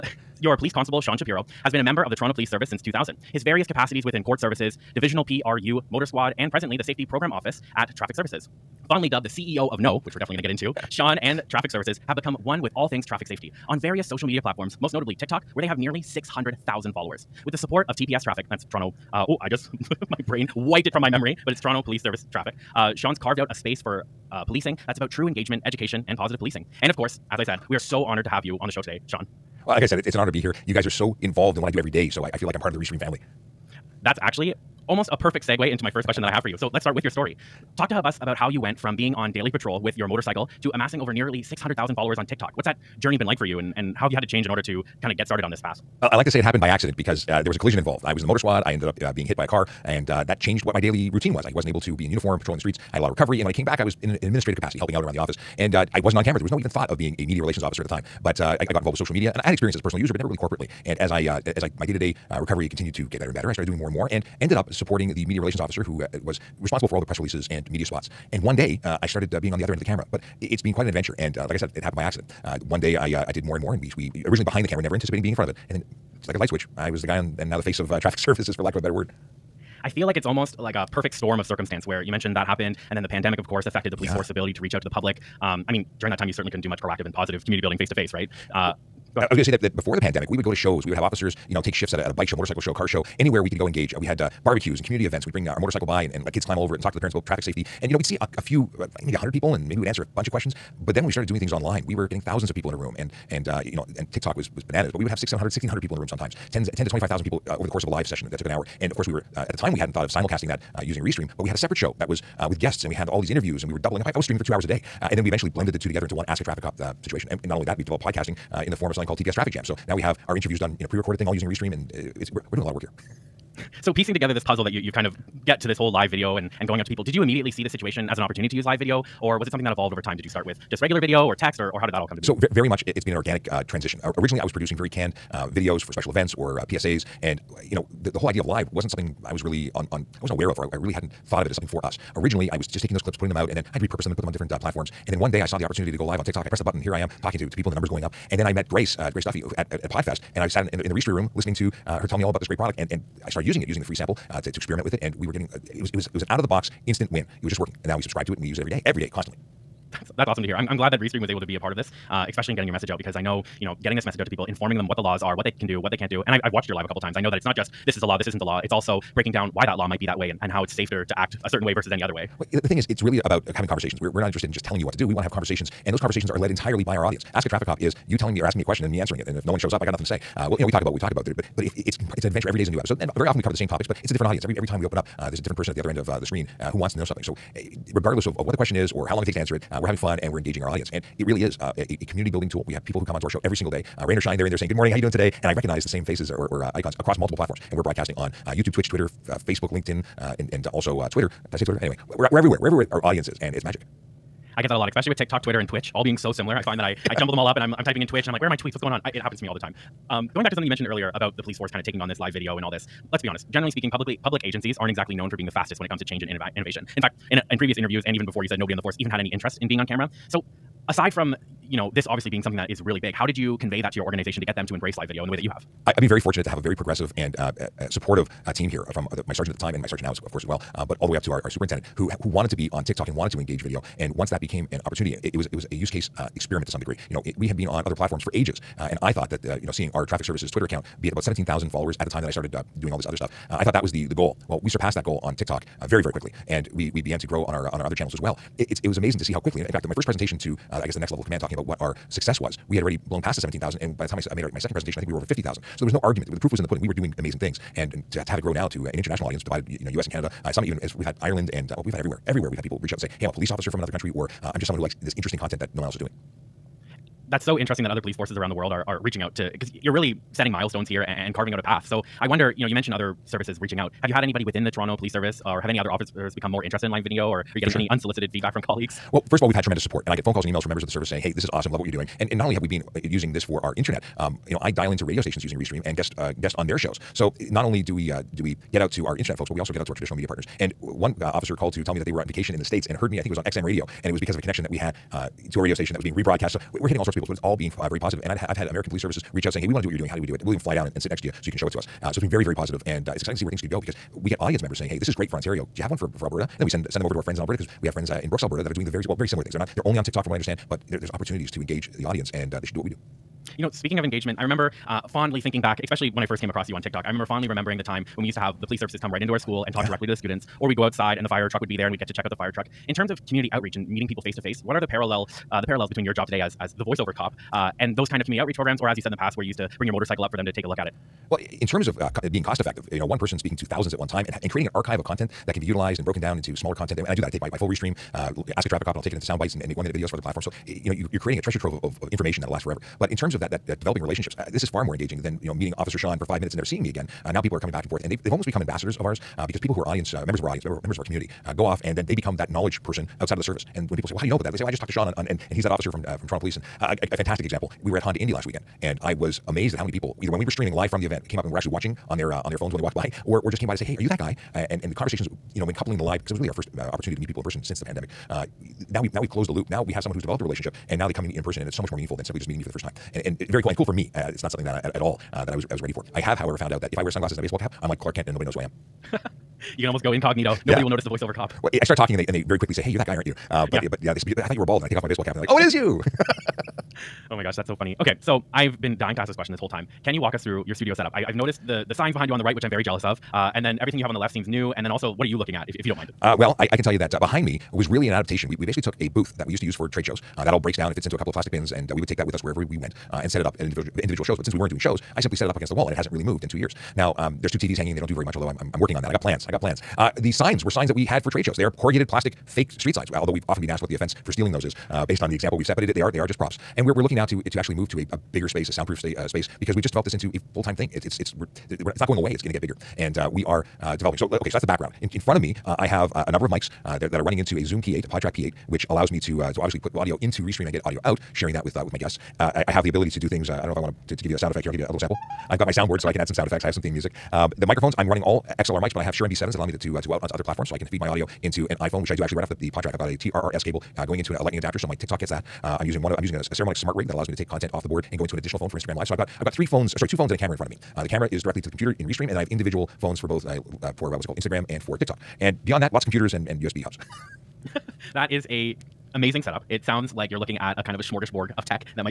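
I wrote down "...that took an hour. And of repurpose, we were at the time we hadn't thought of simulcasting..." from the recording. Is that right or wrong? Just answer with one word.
wrong.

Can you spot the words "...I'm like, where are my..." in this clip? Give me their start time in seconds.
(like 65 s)
208 s.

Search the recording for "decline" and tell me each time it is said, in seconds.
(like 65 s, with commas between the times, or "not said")
not said.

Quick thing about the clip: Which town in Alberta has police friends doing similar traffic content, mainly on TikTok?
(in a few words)
Brooks.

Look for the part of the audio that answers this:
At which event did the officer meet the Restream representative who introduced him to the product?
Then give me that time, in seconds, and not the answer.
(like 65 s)
149 s.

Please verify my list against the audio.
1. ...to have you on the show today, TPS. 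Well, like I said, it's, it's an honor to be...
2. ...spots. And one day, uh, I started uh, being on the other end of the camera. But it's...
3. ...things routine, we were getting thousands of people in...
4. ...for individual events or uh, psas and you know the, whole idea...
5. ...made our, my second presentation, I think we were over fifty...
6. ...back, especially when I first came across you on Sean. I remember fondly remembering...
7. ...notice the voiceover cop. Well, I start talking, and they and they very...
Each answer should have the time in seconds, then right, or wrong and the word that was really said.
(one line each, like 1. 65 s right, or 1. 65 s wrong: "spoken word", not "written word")
1. 28 s wrong: "Sean", not "TPS"
2. 67 s right
3. 101 s wrong: "online", not "routine"
4. 135 s wrong: "special", not "individual"
5. 254 s right
6. 315 s wrong: "TikTok", not "Sean"
7. 380 s right.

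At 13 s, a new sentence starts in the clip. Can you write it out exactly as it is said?
On various social media platforms, most notably TikTok, where they have nearly 600,000 followers.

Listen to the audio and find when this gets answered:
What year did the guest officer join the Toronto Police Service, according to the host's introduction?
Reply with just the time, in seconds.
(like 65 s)
2 s.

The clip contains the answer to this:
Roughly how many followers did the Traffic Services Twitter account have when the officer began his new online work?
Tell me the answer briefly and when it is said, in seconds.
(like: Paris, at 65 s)
17,000, at 241 s.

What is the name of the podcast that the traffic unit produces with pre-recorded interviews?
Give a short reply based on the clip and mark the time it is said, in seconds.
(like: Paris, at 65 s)
TPS Traffic Jam, at 119 s.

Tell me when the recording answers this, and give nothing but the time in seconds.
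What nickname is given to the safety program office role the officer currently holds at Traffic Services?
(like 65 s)
9 s.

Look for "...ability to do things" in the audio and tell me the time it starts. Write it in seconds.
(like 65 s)
432 s.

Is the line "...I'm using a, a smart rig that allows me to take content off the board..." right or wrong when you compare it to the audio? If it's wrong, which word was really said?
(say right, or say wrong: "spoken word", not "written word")
right.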